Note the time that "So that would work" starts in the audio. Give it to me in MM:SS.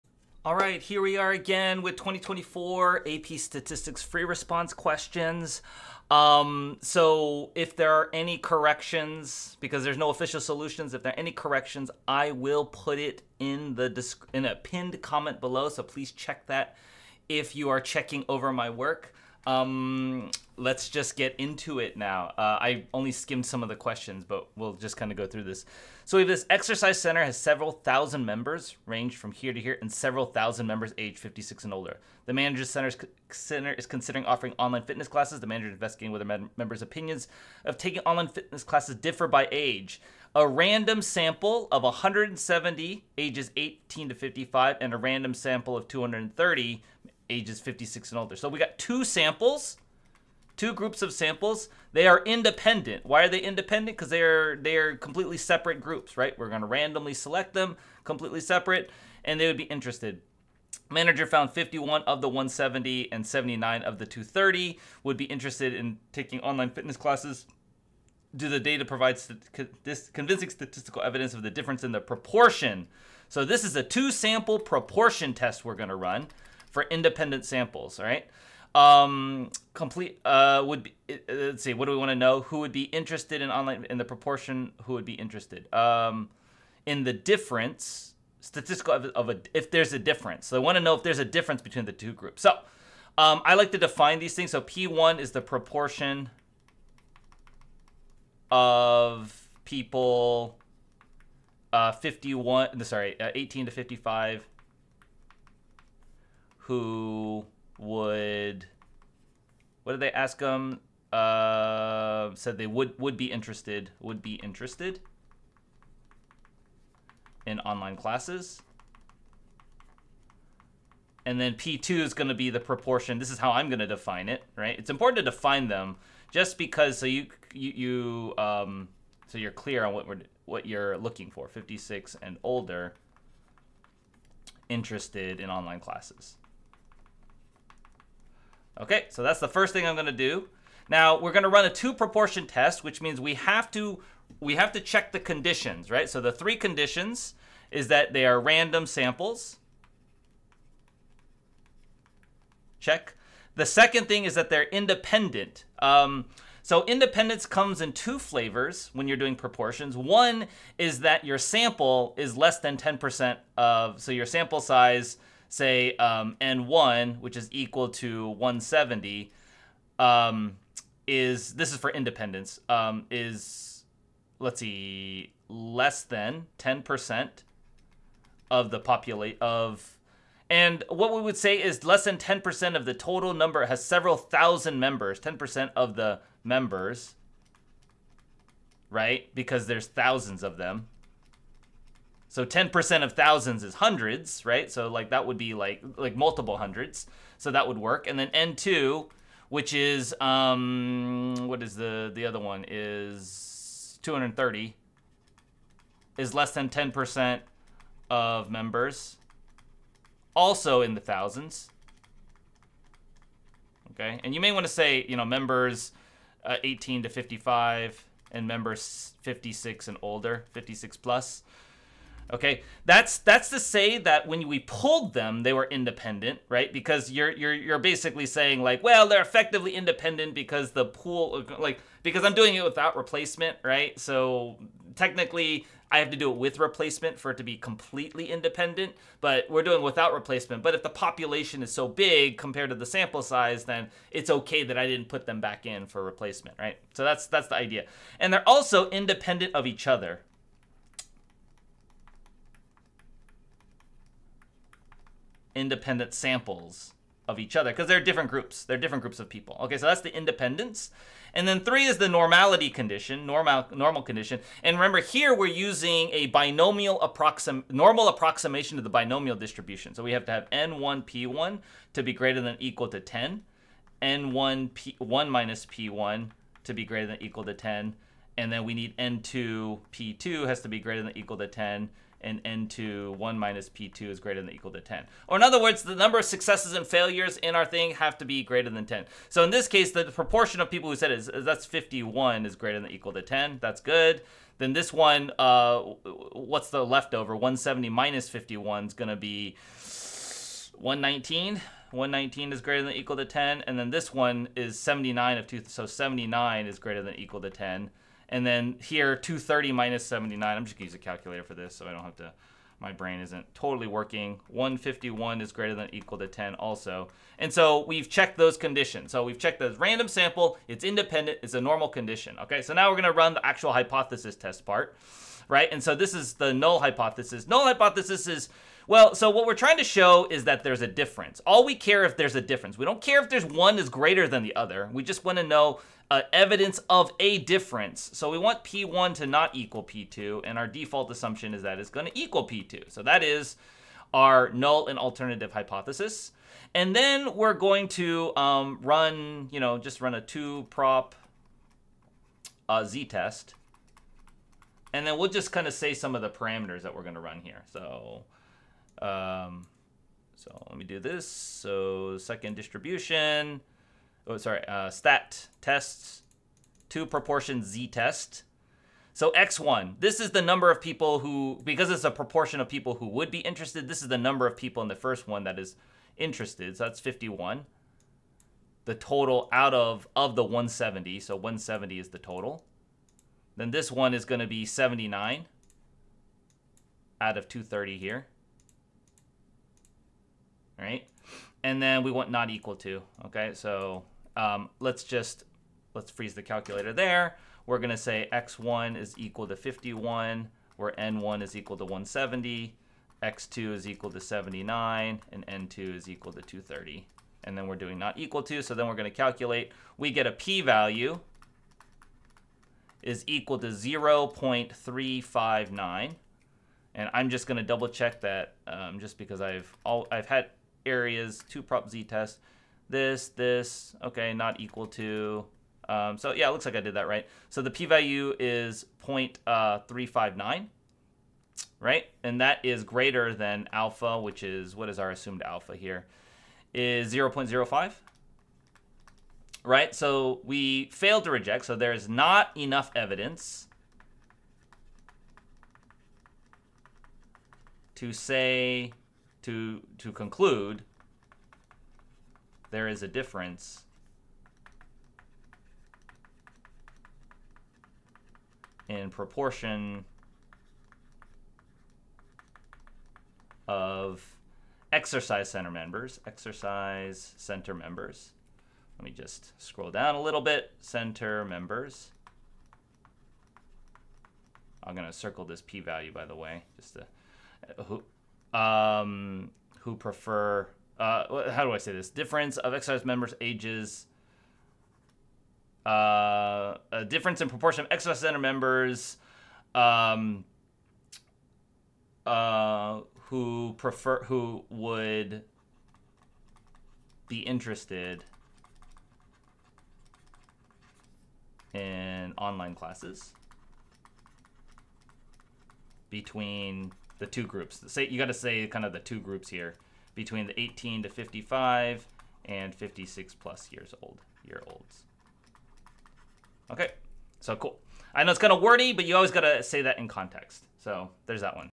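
03:17.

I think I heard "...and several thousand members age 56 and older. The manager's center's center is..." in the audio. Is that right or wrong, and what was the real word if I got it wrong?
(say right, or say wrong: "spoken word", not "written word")
right.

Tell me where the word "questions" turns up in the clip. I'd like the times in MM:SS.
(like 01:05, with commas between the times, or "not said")
00:04, 00:23.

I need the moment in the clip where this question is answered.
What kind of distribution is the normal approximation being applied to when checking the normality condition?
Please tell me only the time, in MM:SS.
04:28.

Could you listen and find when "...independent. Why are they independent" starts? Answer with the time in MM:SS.
00:52.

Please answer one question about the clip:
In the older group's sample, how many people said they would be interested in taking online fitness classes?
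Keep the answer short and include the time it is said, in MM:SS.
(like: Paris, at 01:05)
79, at 01:03.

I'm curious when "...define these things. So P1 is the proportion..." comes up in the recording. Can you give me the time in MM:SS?
01:33.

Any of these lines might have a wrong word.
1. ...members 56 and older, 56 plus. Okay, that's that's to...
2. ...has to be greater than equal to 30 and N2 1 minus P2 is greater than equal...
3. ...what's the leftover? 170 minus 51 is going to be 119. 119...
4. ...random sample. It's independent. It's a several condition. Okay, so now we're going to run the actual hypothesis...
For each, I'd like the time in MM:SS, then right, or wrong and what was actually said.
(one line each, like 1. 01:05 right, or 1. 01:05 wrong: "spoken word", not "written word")
1. 03:38 right
2. 04:40 wrong: "10", not "30"
3. 04:56 right
4. 05:19 wrong: "normal", not "several".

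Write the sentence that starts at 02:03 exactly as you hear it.
This is how I'm going to define it, right?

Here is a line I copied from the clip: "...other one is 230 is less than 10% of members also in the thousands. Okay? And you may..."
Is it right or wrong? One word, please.
right.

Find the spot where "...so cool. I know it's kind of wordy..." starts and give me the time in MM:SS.
08:37.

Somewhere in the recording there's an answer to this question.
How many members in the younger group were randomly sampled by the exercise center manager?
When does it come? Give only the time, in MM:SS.
00:40.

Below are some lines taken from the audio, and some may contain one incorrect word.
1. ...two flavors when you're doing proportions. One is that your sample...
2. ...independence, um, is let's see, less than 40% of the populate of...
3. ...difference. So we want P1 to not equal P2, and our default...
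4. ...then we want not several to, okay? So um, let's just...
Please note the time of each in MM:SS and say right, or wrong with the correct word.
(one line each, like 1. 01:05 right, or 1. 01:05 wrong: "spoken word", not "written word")
1. 02:37 right
2. 02:51 wrong: "10", not "40"
3. 05:37 right
4. 06:31 wrong: "equal", not "several".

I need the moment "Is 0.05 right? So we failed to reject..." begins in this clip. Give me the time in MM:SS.
07:16.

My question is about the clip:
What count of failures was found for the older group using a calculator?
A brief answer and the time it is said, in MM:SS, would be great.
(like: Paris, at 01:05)
151, at 05:14.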